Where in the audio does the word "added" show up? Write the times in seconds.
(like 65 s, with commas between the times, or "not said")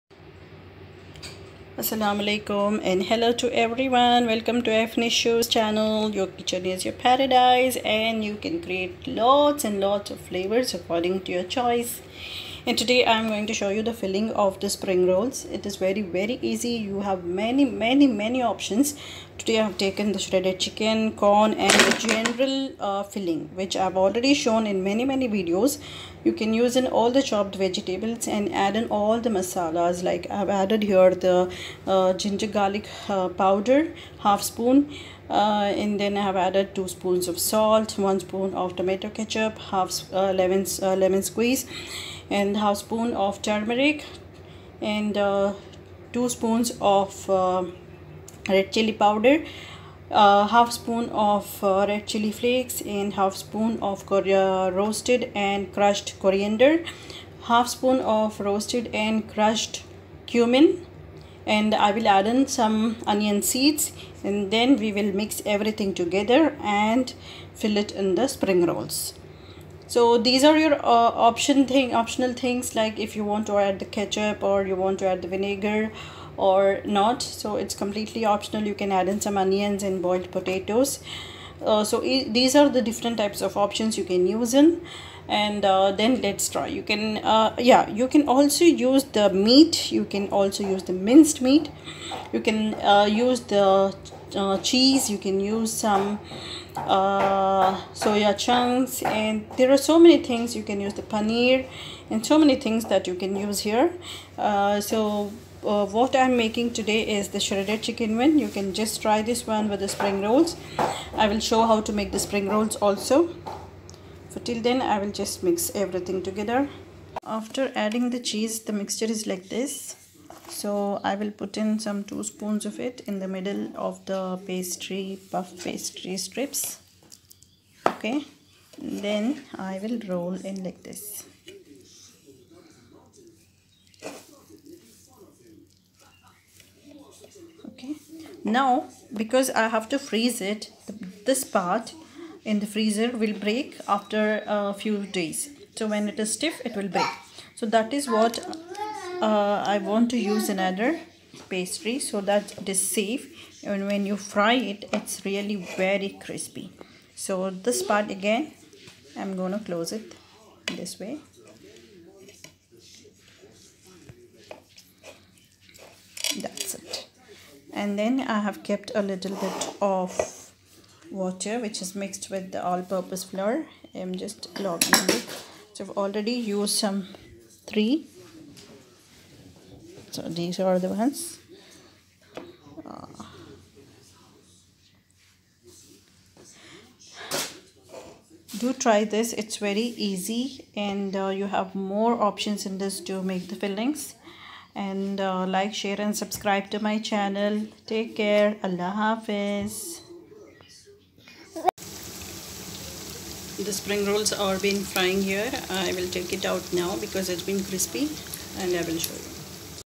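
30 s, 36 s.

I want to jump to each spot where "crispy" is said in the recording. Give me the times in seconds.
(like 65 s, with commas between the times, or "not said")
156 s, 207 s.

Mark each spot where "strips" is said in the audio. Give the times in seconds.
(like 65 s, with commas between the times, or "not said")
126 s.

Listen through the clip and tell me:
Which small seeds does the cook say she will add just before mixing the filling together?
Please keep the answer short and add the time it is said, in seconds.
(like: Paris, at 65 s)
onion seeds, at 63 s.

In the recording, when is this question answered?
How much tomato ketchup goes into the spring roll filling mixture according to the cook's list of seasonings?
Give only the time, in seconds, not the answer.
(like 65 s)
37 s.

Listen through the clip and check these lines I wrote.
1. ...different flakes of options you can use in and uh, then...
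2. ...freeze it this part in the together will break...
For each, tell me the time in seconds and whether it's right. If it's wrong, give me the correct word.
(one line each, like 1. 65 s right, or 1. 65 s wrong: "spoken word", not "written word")
1. 82 s wrong: "types", not "flakes"
2. 140 s wrong: "freezer", not "together".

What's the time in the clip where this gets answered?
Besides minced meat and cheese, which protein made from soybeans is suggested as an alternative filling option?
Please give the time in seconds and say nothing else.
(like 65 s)
97 s.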